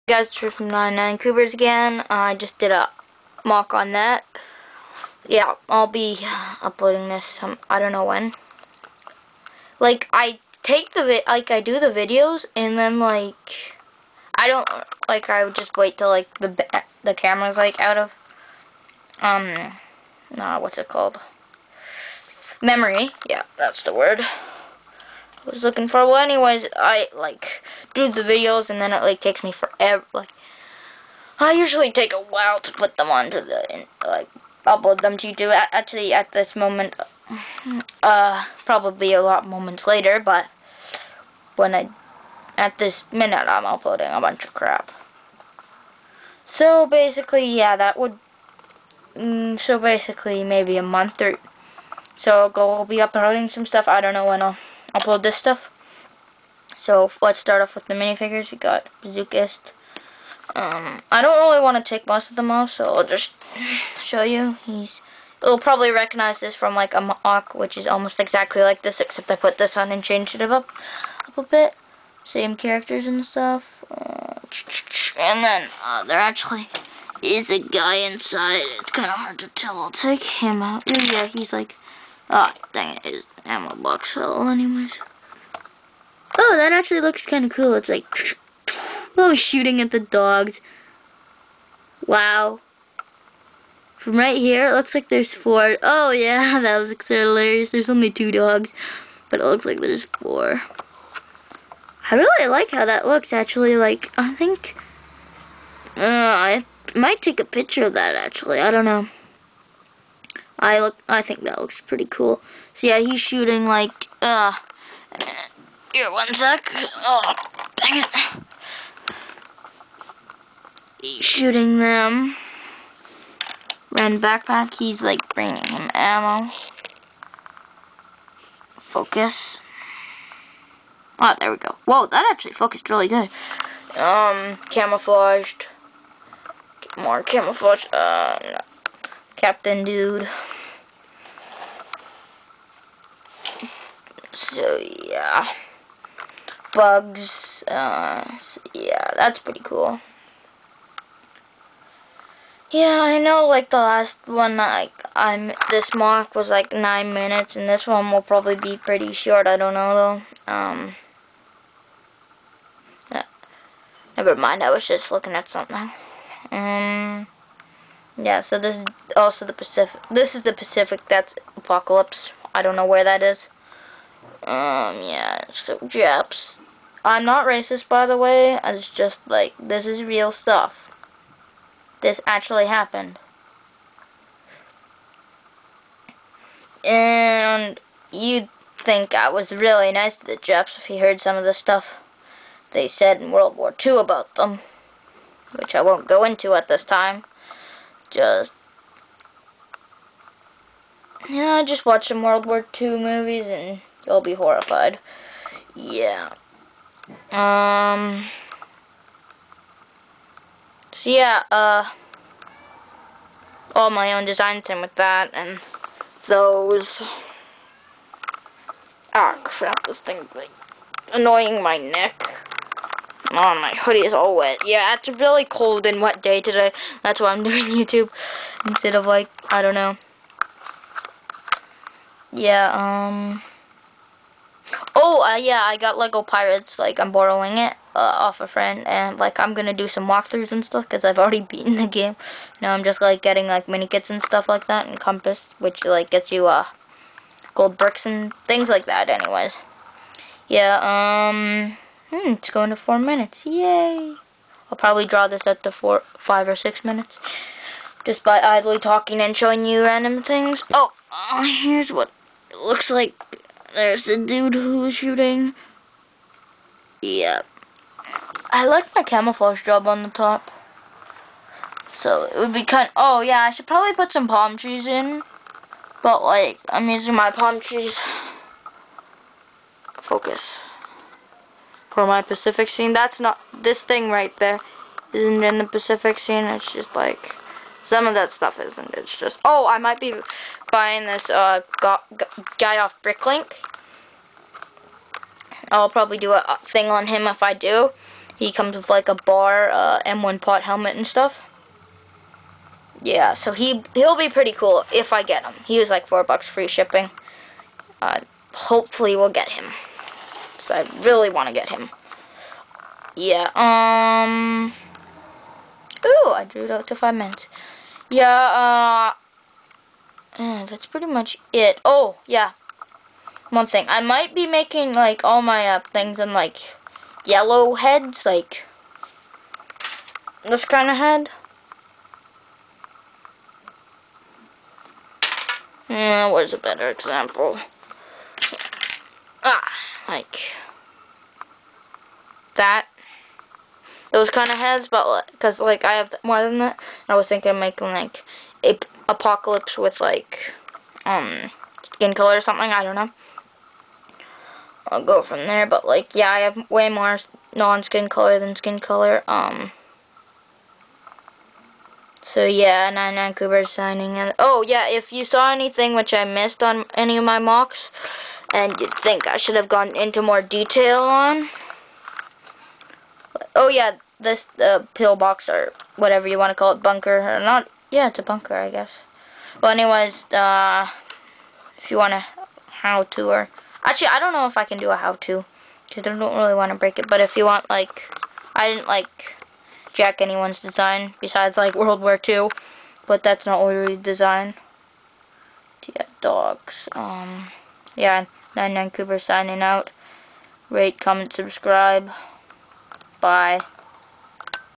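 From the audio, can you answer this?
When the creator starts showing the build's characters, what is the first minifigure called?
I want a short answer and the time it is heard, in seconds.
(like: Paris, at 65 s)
Bazookist, at 59 s.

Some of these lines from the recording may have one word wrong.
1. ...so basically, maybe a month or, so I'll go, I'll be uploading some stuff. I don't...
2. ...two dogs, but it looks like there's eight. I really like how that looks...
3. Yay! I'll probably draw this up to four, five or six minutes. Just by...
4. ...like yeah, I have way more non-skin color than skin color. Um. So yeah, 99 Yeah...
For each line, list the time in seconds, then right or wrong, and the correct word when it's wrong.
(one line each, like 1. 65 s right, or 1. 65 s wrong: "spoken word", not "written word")
1. 49 s right
2. 98 s wrong: "four", not "eight"
3. 253 s right
4. 355 s wrong: "Coobear", not "Yeah".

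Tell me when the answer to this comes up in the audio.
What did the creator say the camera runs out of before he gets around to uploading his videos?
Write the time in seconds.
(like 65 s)
22 s.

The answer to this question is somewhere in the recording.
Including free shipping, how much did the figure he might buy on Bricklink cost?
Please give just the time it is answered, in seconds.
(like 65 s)
306 s.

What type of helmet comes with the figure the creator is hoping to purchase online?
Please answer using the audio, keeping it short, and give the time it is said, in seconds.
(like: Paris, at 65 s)
M1 pot helmet, at 300 s.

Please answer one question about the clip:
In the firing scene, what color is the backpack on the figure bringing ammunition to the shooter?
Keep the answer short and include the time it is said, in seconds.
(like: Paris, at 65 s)
Red, at 123 s.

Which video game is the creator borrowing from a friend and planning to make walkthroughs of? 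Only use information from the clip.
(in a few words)
Lego Pirates.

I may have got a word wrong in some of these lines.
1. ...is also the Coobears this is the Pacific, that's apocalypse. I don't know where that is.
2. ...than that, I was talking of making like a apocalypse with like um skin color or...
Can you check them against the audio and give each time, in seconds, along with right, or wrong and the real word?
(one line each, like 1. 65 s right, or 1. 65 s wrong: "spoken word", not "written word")
1. 168 s wrong: "Pacific", not "Coobears"
2. 346 s wrong: "thinking", not "talking".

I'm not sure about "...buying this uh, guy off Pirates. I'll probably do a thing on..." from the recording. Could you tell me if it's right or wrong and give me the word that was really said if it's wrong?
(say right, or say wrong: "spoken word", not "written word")
wrong: "Bricklink", not "Pirates".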